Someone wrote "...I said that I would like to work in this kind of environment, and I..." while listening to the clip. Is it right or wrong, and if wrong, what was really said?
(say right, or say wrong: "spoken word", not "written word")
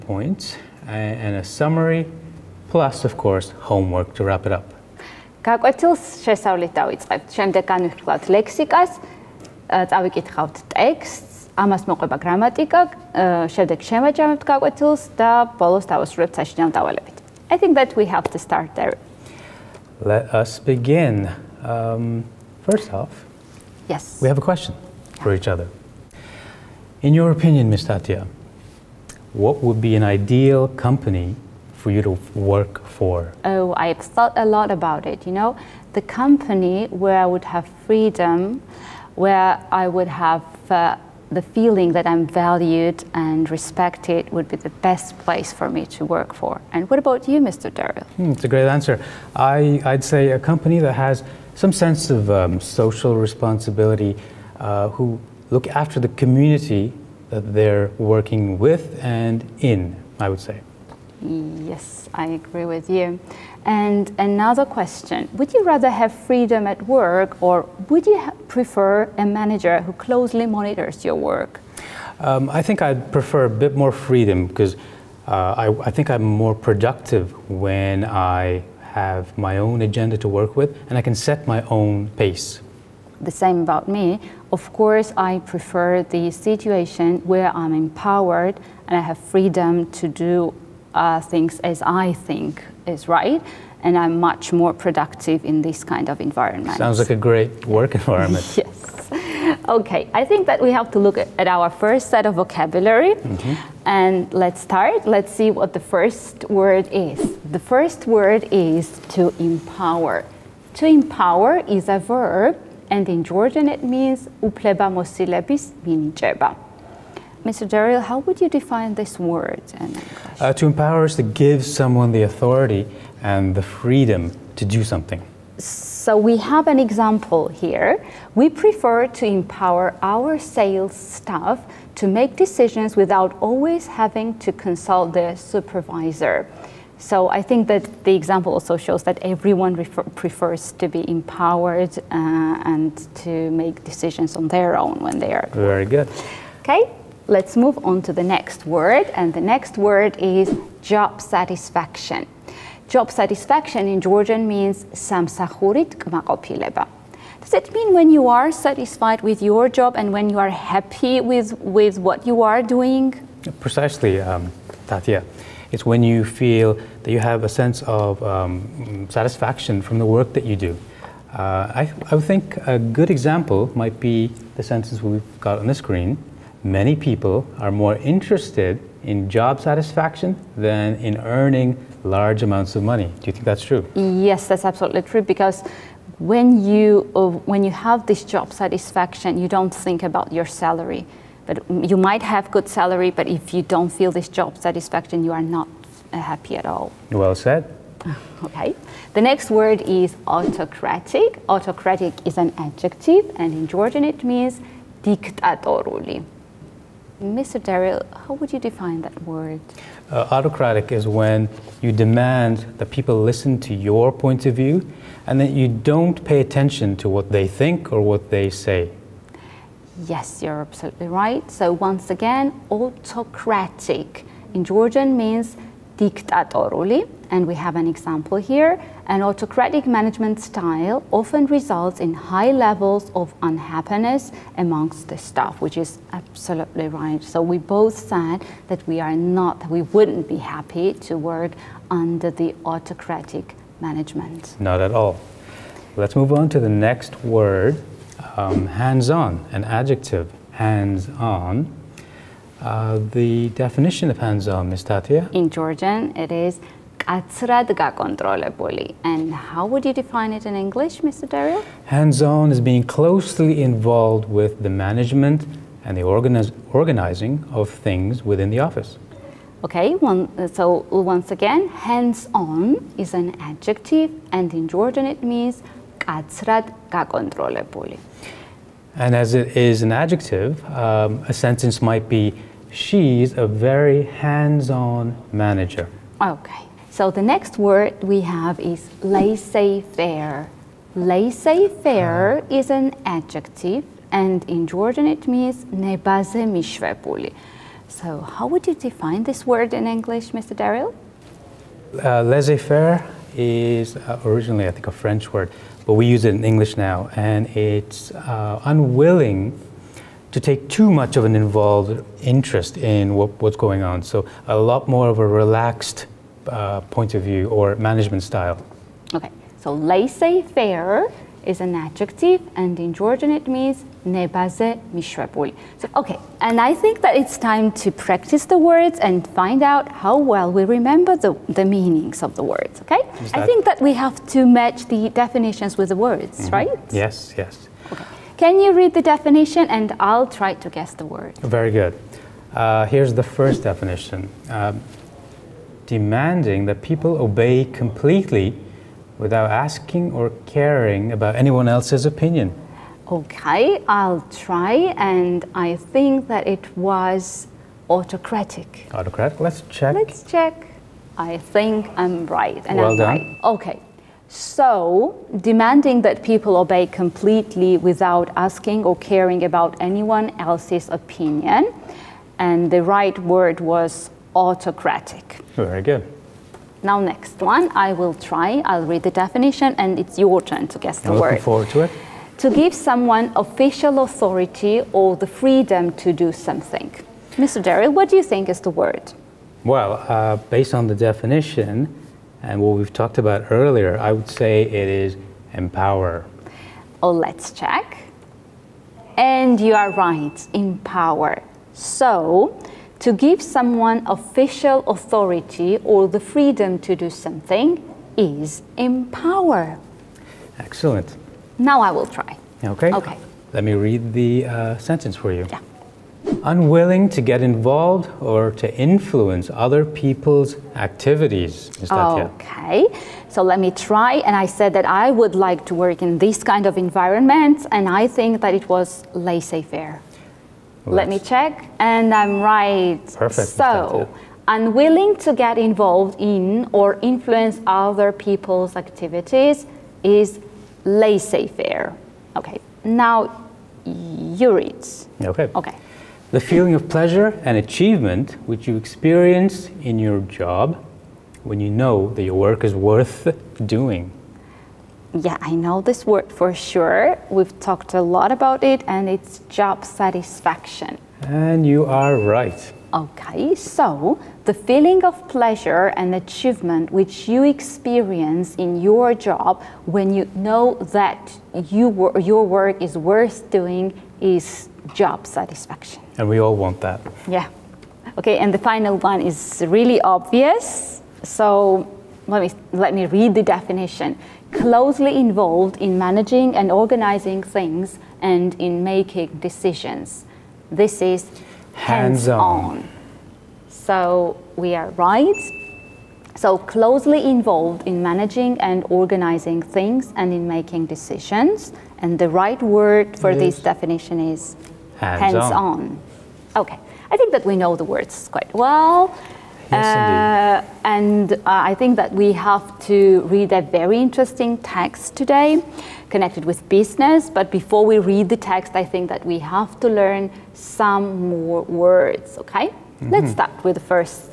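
right.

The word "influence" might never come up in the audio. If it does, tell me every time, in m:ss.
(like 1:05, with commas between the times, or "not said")
6:58, 7:17.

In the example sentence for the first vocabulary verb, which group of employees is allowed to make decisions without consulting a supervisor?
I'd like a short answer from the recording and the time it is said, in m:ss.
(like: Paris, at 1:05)
sales staff, at 2:10.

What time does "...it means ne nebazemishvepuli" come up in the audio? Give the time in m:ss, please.
4:55.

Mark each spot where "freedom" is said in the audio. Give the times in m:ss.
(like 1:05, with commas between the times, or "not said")
0:37, 1:06, 1:13, 1:29, 2:03, 6:25, 6:46.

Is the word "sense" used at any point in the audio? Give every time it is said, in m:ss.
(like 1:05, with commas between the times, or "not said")
0:51, 2:47.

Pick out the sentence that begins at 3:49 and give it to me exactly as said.
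An autocratic management style often results in high levels of unhappiness amongst the staff, which is absolutely right.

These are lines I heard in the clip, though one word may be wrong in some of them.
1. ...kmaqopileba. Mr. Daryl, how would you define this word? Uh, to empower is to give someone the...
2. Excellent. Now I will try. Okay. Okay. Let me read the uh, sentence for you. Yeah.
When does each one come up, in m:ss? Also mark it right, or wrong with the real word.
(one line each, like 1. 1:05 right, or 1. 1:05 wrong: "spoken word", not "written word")
1. 1:55 wrong: "minijeba", not "kmaqopileba"
2. 6:50 right.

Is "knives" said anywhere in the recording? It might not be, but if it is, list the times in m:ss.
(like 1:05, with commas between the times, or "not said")
not said.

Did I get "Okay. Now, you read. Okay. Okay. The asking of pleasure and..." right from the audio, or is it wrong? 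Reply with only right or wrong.
wrong.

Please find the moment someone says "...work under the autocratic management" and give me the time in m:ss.
4:01.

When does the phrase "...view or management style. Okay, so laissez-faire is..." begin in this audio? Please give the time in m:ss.
5:17.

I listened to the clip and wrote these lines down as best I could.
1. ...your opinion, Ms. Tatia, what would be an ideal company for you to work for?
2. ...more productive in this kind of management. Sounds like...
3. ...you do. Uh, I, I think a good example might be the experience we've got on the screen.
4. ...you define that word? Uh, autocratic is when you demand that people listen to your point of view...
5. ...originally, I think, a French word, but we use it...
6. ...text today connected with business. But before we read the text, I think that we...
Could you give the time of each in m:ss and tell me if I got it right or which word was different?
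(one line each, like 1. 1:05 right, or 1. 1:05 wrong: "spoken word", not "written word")
1. 0:27 right
2. 1:34 wrong: "environment", not "management"
3. 2:50 wrong: "sentence", not "experience"
4. 3:28 right
5. 5:04 right
6. 8:34 right.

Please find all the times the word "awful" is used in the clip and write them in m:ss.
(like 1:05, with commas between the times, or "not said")
not said.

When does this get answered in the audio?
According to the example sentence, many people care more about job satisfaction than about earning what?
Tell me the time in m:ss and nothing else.
3:02.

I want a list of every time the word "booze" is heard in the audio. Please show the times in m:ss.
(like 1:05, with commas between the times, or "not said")
not said.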